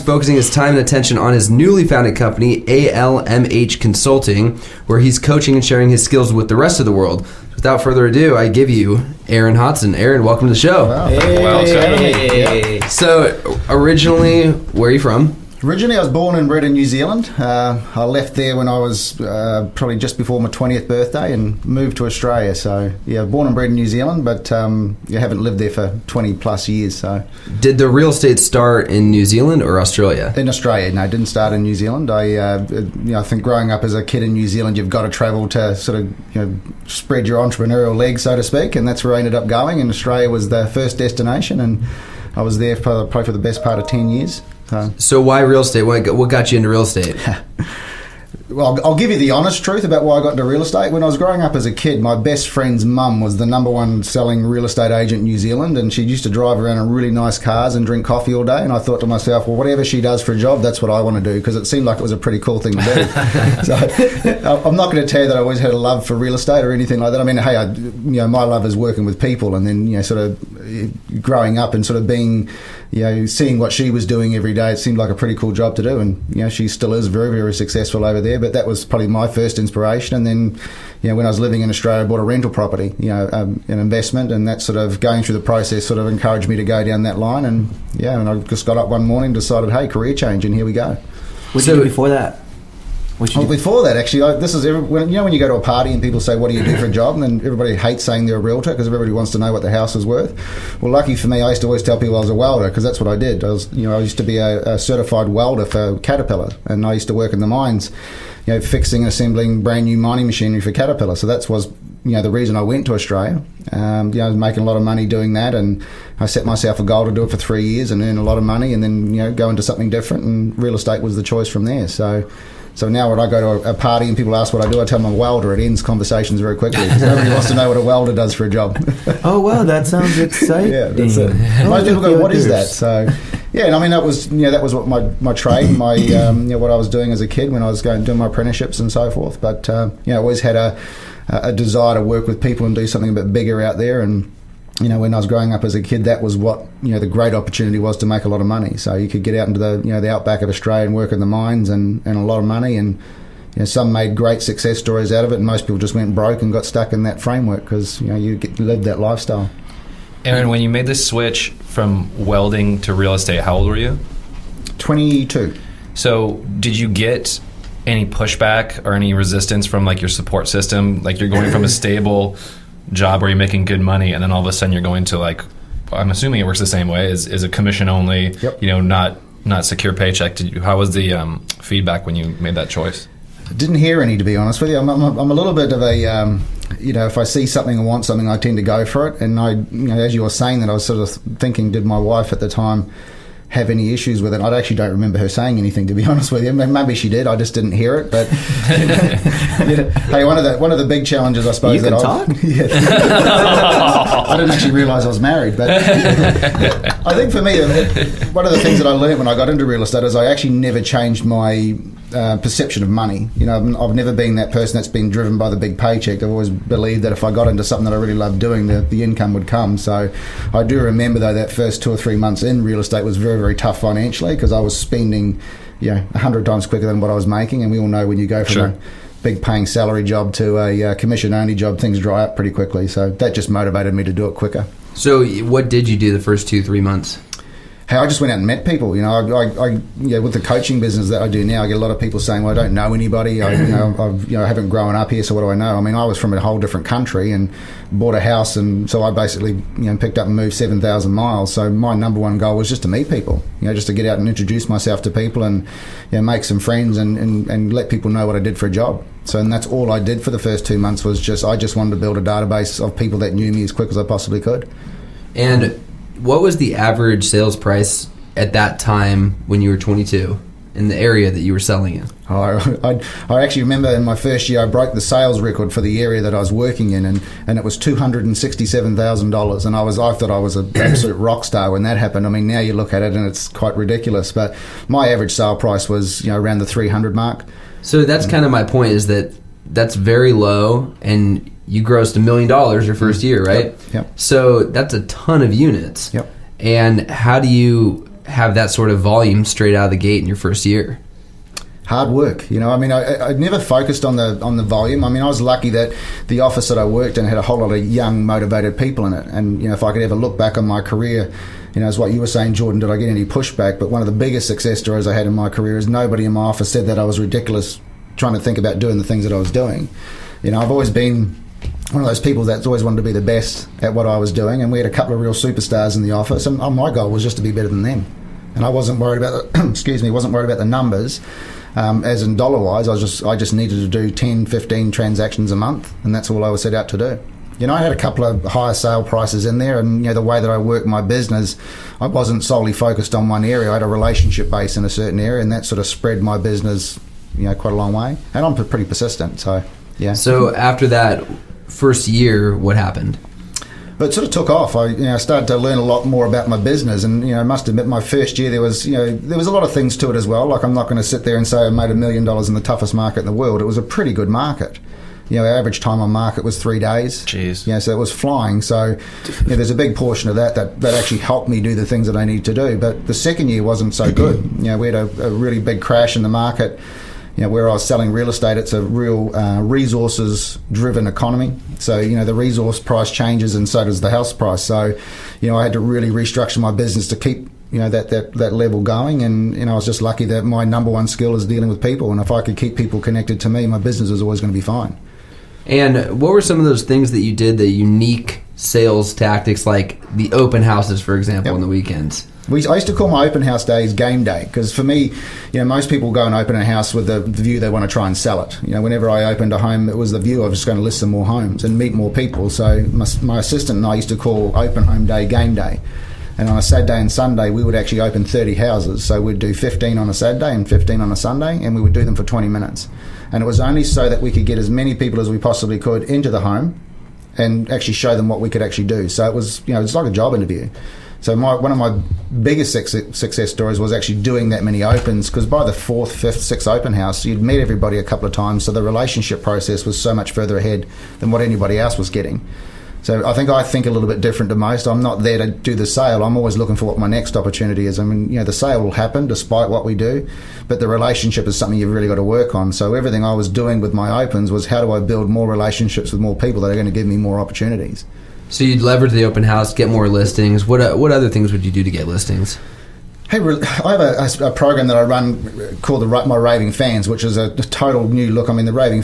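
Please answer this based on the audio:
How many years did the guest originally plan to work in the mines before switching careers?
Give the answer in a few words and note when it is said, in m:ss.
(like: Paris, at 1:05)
3, at 1:57.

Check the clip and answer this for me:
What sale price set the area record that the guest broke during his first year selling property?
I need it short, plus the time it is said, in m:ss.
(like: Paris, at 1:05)
$267,000, at 4:37.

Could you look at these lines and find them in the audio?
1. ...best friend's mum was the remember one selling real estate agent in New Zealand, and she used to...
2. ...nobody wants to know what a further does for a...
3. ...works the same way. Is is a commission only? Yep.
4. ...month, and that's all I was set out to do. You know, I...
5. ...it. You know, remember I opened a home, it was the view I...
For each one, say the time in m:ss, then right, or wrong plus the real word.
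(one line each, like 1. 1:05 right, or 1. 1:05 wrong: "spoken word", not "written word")
1. 0:52 wrong: "number", not "remember"
2. 2:07 wrong: "welder", not "further"
3. 2:56 right
4. 5:35 right
5. 6:48 wrong: "whenever", not "remember".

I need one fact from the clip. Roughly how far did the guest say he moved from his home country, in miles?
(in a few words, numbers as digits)
7,000 miles.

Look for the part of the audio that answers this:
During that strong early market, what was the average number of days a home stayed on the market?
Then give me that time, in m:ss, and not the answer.
6:06.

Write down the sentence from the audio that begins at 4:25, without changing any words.
And what was the average sales price at that time when you were 22 in the area that you were selling in?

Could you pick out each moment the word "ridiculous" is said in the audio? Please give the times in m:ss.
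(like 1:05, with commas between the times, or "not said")
4:43, 5:17.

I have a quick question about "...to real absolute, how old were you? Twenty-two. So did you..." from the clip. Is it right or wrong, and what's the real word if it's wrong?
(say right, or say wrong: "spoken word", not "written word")
wrong: "estate", not "absolute".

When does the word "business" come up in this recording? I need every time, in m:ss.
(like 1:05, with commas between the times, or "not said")
4:00, 5:41, 5:46, 5:56, 6:26, 6:33.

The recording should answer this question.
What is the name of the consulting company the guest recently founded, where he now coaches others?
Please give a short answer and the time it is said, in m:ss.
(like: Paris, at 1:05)
ALMH Consulting, at 0:02.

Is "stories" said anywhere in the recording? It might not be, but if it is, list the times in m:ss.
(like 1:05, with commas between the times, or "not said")
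2:34, 5:14, 7:13.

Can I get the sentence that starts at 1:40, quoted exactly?
Well, lucky for me, I used to always tell people I was a welder because that's what I did.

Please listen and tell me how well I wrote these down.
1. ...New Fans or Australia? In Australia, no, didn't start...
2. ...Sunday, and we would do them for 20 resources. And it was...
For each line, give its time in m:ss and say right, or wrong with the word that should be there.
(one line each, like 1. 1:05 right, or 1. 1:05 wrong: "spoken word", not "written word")
1. 0:29 wrong: "Zealand", not "Fans"
2. 7:01 wrong: "minutes", not "resources".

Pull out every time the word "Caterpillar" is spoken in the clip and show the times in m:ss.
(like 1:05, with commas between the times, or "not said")
1:45, 1:50.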